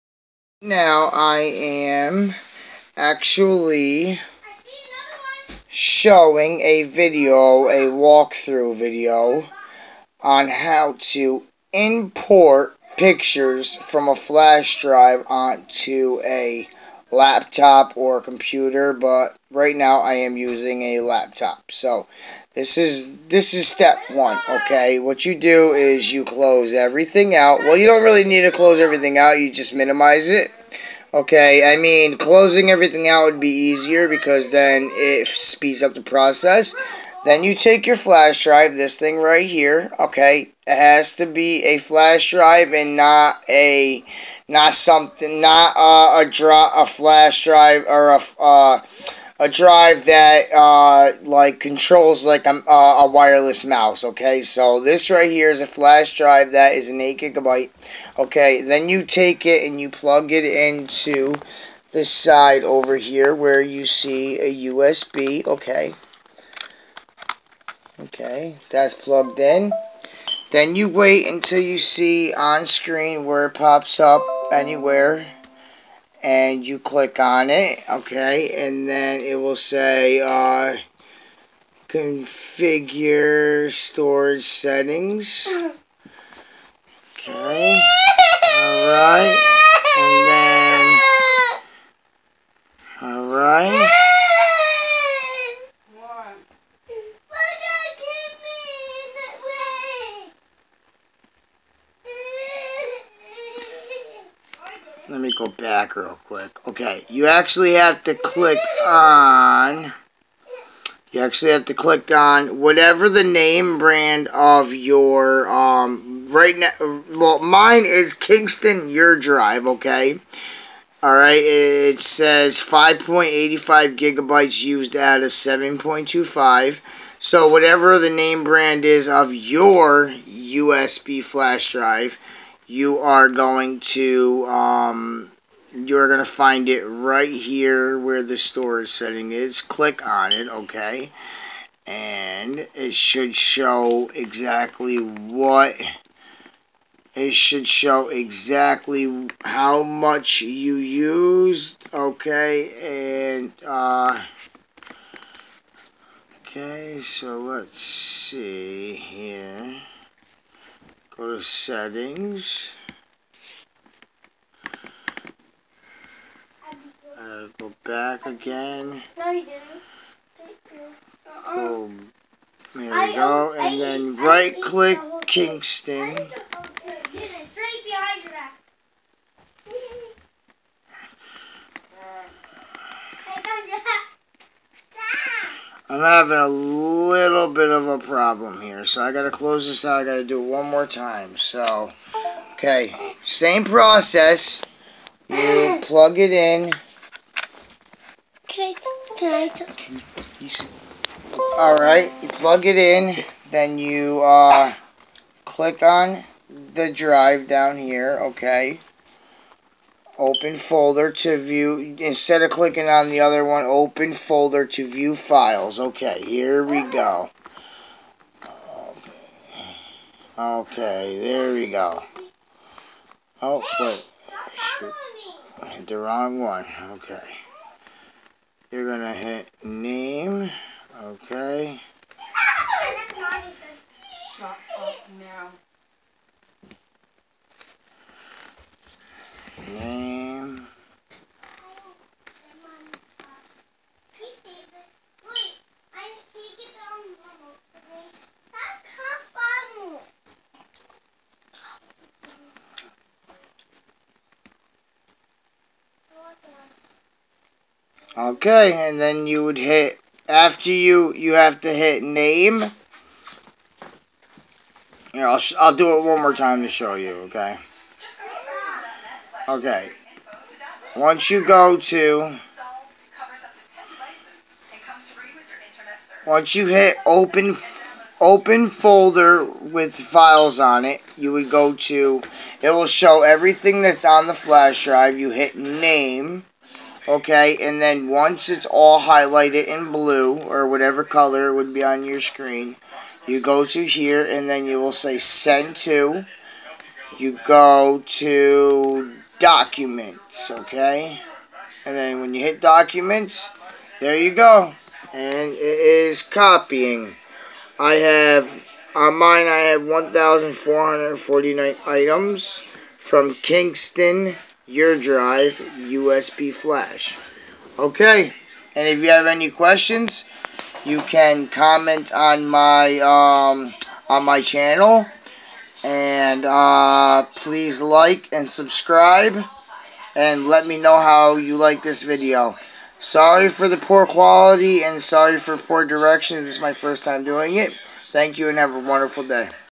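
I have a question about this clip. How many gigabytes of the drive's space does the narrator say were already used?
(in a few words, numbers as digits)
5.85.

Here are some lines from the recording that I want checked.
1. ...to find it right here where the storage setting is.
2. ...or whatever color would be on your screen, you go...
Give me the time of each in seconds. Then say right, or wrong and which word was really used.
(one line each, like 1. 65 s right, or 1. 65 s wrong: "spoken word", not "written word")
1. 136 s right
2. 290 s right.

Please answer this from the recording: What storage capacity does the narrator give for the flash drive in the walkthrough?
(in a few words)
8 gigabytes.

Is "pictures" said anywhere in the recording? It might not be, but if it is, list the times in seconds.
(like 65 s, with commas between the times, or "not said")
12 s.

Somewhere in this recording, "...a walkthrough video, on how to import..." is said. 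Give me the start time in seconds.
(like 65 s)
7 s.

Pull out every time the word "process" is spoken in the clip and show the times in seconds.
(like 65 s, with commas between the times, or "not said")
36 s, 193 s.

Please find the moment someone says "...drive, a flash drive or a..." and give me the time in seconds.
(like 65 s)
46 s.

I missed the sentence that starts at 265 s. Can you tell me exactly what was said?
Here, I'll, I'll do it one more time to show you, okay?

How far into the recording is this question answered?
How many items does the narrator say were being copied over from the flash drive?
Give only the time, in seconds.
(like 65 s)
309 s.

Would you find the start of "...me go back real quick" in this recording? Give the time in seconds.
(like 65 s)
105 s.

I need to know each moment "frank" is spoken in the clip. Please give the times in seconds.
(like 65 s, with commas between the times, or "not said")
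not said.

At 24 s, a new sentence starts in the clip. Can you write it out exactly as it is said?
What you do is you close everything out.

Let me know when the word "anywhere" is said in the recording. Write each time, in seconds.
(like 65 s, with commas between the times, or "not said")
74 s.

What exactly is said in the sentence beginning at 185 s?
I'm having a little bit of a problem here, so I gotta close this out.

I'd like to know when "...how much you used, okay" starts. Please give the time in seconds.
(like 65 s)
149 s.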